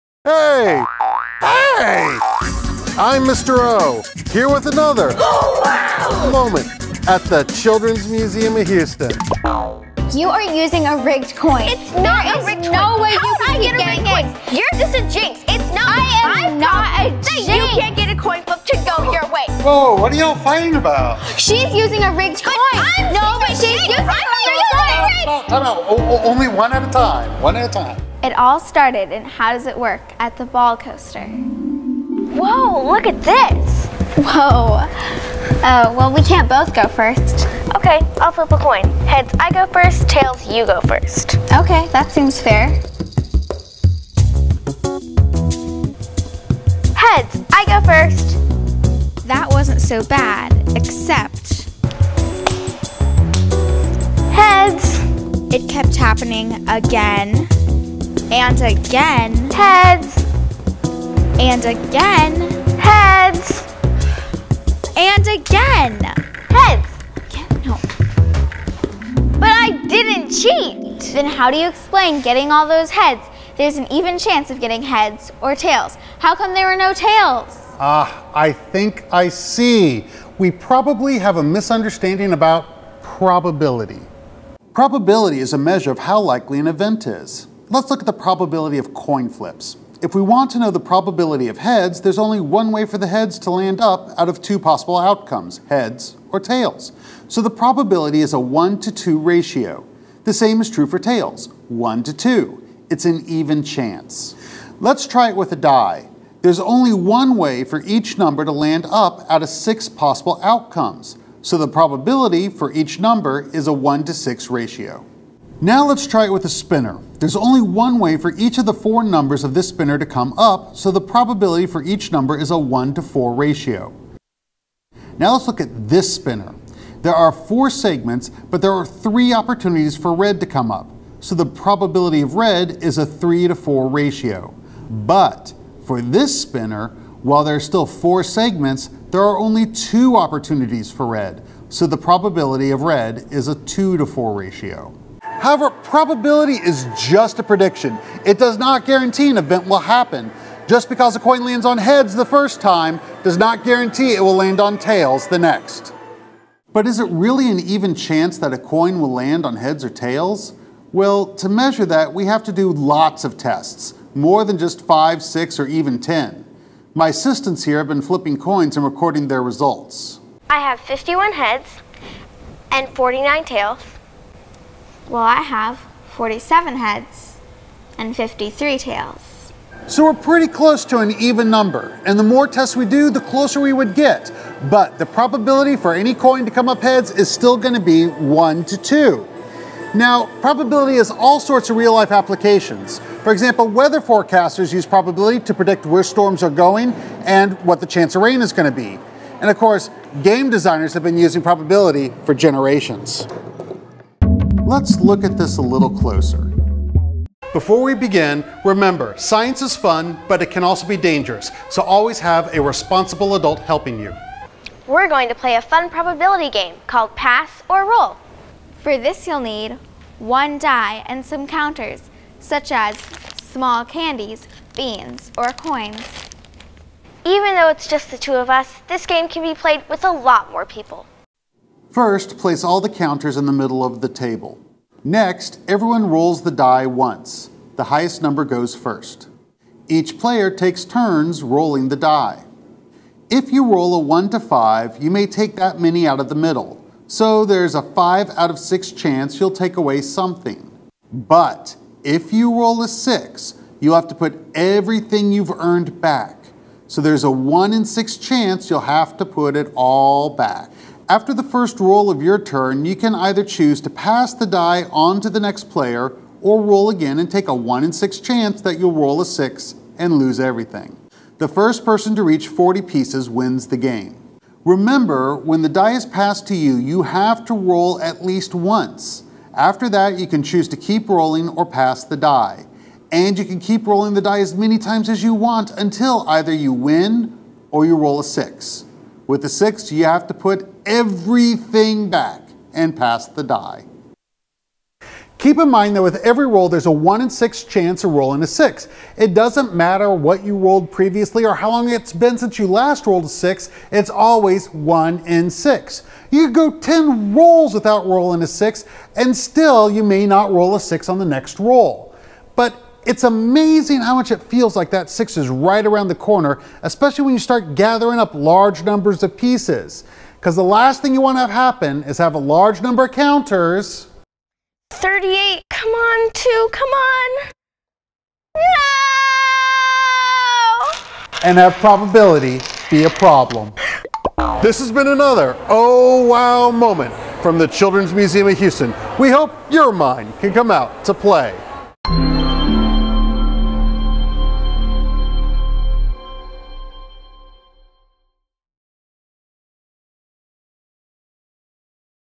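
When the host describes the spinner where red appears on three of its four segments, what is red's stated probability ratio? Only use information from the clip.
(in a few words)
3 to 4.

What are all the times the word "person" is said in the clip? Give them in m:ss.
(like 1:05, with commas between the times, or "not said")
4:31.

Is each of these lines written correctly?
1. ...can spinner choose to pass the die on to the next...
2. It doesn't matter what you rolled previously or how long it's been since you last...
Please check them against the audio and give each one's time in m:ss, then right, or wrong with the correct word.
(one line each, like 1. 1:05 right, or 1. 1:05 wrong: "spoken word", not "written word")
1. 4:22 wrong: "either", not "spinner"
2. 4:59 right.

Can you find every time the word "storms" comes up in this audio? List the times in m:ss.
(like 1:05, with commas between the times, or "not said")
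3:16.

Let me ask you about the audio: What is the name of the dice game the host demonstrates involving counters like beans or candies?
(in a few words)
Pass or Roll.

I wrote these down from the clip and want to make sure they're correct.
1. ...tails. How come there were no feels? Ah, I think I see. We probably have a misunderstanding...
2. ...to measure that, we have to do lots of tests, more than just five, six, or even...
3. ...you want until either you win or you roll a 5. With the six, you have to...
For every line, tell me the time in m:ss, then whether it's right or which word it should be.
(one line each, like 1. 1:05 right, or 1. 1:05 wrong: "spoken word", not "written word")
1. 1:15 wrong: "tails", not "feels"
2. 2:41 right
3. 4:45 wrong: "6", not "5".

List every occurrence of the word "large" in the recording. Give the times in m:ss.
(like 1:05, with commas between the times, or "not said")
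5:18, 5:22.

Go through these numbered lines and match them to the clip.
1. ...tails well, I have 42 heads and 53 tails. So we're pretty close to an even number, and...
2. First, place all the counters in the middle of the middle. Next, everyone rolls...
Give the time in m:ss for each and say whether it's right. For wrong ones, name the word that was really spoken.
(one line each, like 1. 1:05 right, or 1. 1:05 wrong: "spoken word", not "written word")
1. 2:53 wrong: "47", not "42"
2. 3:51 wrong: "table", not "middle".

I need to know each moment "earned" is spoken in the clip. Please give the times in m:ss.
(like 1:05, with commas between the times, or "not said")
4:15.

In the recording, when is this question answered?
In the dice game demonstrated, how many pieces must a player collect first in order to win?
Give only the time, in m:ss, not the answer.
4:32.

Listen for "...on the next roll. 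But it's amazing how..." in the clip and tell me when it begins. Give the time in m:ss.
5:11.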